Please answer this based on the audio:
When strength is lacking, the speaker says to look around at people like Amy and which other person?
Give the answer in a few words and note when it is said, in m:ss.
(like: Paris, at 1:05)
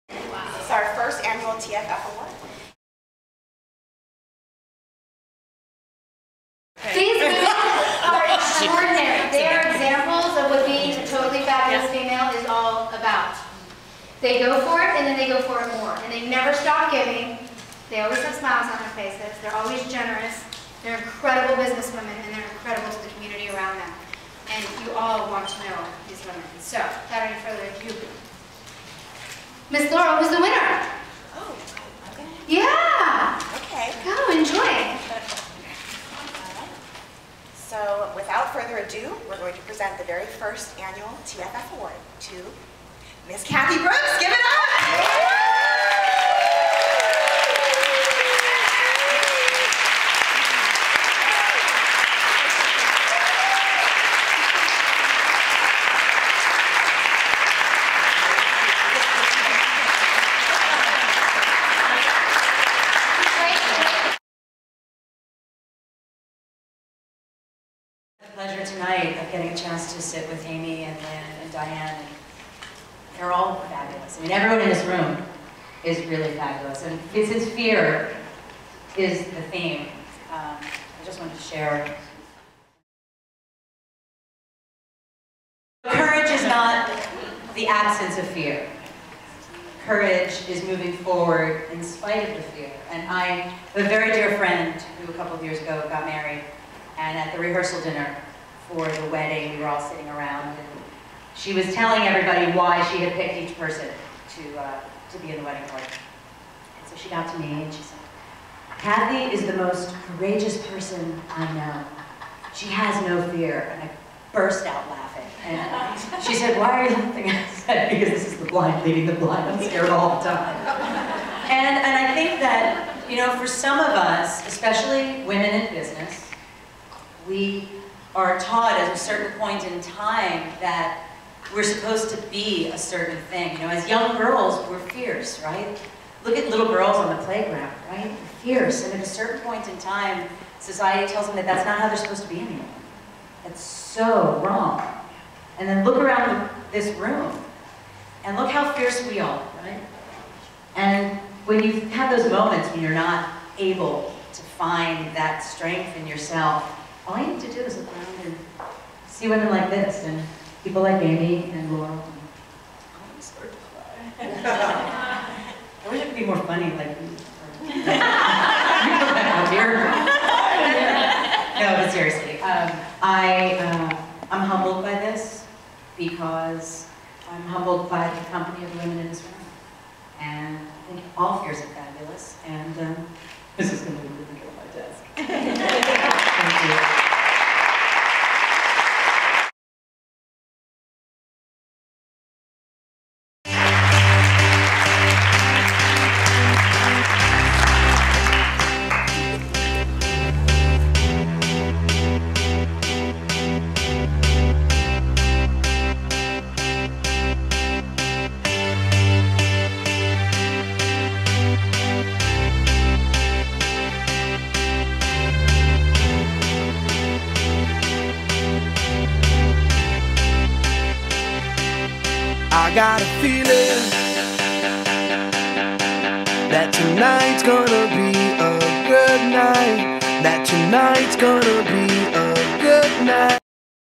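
Laurel, at 2:41.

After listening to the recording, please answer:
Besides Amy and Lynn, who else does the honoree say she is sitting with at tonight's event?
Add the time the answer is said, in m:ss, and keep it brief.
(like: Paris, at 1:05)
Diane, at 1:11.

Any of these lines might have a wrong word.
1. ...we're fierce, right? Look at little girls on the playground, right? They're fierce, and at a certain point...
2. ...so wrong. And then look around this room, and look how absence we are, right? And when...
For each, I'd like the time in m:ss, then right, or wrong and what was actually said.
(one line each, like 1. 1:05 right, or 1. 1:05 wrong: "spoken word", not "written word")
1. 2:14 right
2. 2:23 wrong: "fierce", not "absence".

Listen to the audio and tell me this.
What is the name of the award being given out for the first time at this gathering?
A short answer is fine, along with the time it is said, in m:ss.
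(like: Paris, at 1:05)
TFF Award, at 0:41.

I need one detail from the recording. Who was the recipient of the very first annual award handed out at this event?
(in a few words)
Cathy Brooks.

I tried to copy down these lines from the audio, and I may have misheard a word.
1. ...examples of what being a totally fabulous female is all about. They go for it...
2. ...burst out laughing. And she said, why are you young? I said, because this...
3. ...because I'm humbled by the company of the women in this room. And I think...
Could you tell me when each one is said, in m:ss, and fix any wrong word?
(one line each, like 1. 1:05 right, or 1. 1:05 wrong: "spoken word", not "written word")
1. 0:09 right
2. 1:54 wrong: "laughing", not "young"
3. 2:55 right.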